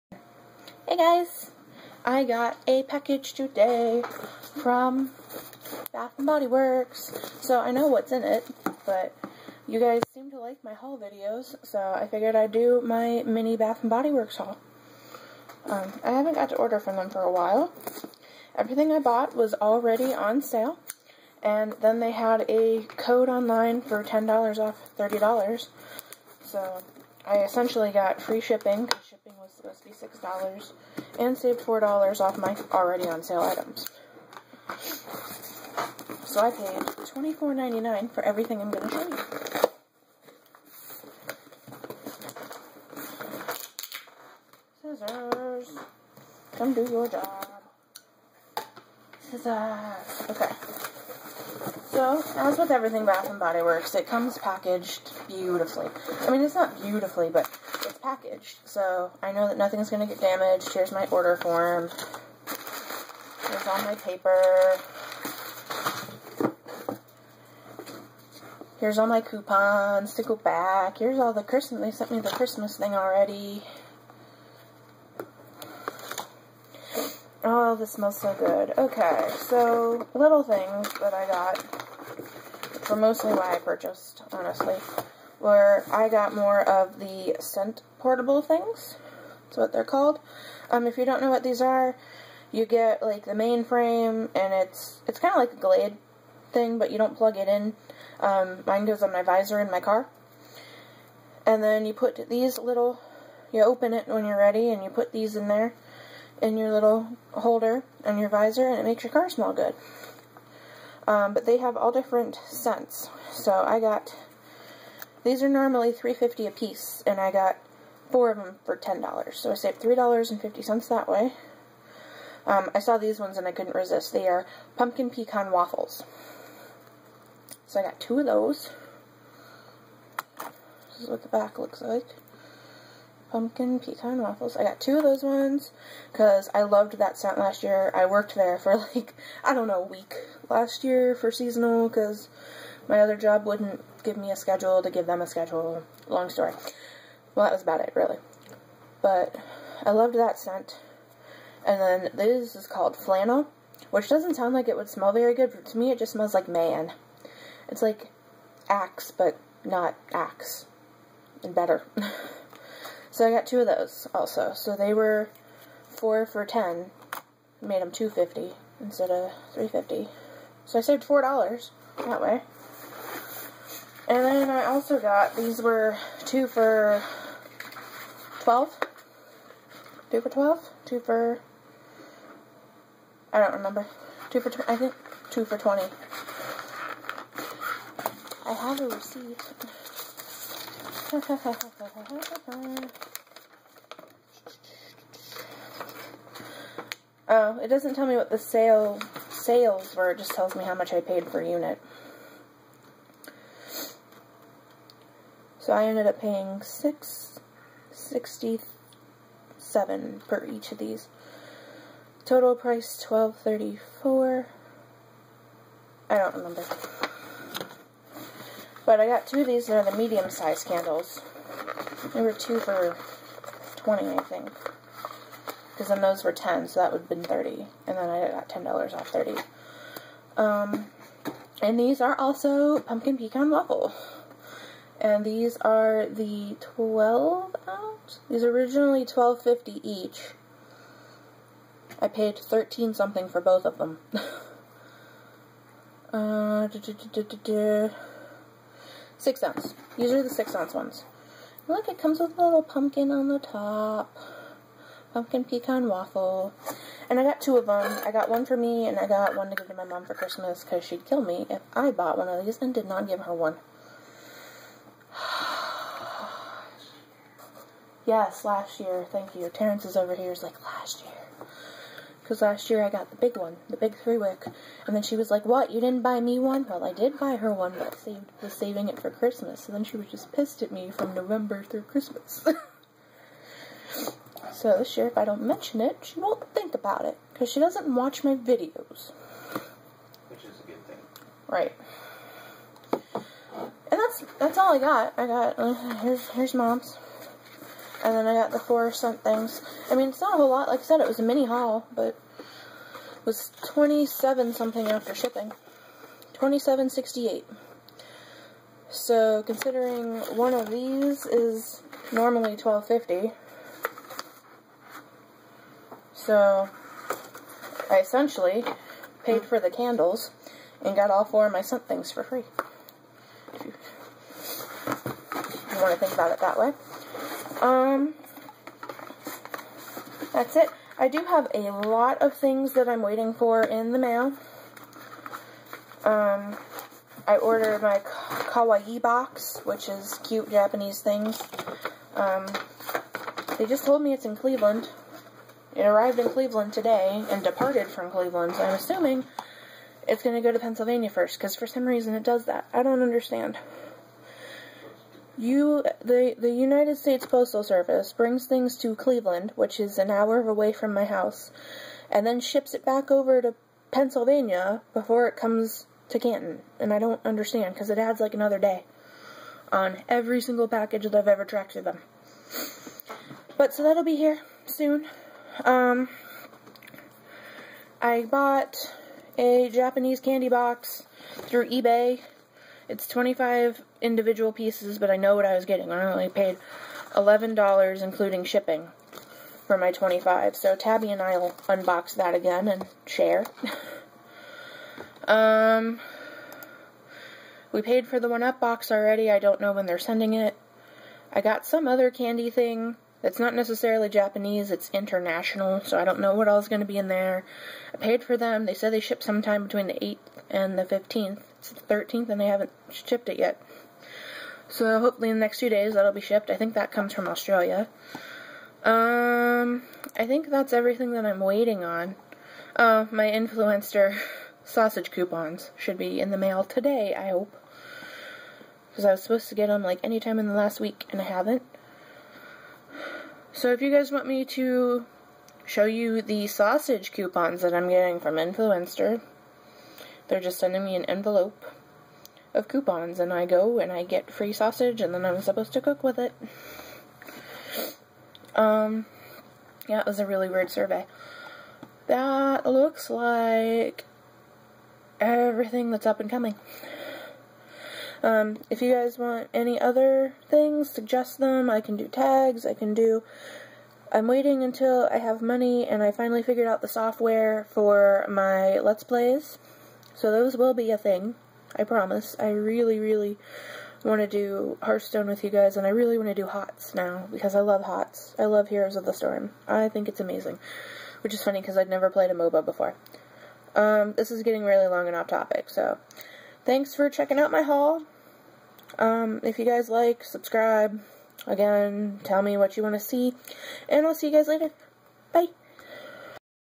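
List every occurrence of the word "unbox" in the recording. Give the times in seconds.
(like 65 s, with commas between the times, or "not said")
391 s.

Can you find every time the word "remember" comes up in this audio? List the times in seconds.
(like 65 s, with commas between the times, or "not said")
183 s, 216 s.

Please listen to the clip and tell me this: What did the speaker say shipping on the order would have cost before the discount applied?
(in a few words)
$6.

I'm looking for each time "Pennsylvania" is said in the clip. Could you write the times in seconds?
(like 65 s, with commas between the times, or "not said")
350 s, 363 s.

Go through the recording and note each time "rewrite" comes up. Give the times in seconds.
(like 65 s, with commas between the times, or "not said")
not said.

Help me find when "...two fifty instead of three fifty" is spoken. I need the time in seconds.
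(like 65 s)
167 s.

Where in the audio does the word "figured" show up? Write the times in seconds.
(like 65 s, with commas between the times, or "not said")
12 s, 466 s.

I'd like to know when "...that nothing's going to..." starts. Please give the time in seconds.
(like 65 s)
59 s.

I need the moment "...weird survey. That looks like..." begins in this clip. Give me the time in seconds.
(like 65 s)
450 s.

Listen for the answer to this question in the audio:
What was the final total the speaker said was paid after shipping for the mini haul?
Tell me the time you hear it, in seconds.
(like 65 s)
306 s.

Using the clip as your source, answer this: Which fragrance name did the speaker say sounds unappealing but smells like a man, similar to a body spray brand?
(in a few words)
flannel.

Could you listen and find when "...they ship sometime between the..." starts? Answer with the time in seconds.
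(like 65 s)
408 s.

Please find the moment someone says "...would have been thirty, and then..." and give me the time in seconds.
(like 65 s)
226 s.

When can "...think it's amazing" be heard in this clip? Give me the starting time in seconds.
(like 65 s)
479 s.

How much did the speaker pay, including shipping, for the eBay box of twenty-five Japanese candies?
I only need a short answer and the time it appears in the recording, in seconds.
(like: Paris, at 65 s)
$11, at 387 s.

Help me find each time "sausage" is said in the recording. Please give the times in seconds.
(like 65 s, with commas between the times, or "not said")
424 s, 436 s, 444 s.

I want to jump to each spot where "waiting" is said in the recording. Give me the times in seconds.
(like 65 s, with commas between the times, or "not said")
333 s, 421 s, 464 s.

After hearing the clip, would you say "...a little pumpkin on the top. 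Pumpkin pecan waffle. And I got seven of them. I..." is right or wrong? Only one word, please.
wrong.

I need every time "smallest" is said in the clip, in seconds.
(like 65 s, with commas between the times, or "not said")
not said.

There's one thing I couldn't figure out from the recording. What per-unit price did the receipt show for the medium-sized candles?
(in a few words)
$6.67.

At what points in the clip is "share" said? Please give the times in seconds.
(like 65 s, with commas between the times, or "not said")
393 s.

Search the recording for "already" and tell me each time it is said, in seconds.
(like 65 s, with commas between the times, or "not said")
19 s, 32 s, 72 s, 398 s.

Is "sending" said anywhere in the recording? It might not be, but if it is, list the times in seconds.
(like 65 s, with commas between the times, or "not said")
399 s, 440 s.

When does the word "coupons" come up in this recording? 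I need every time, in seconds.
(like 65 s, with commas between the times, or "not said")
69 s, 425 s, 437 s, 442 s.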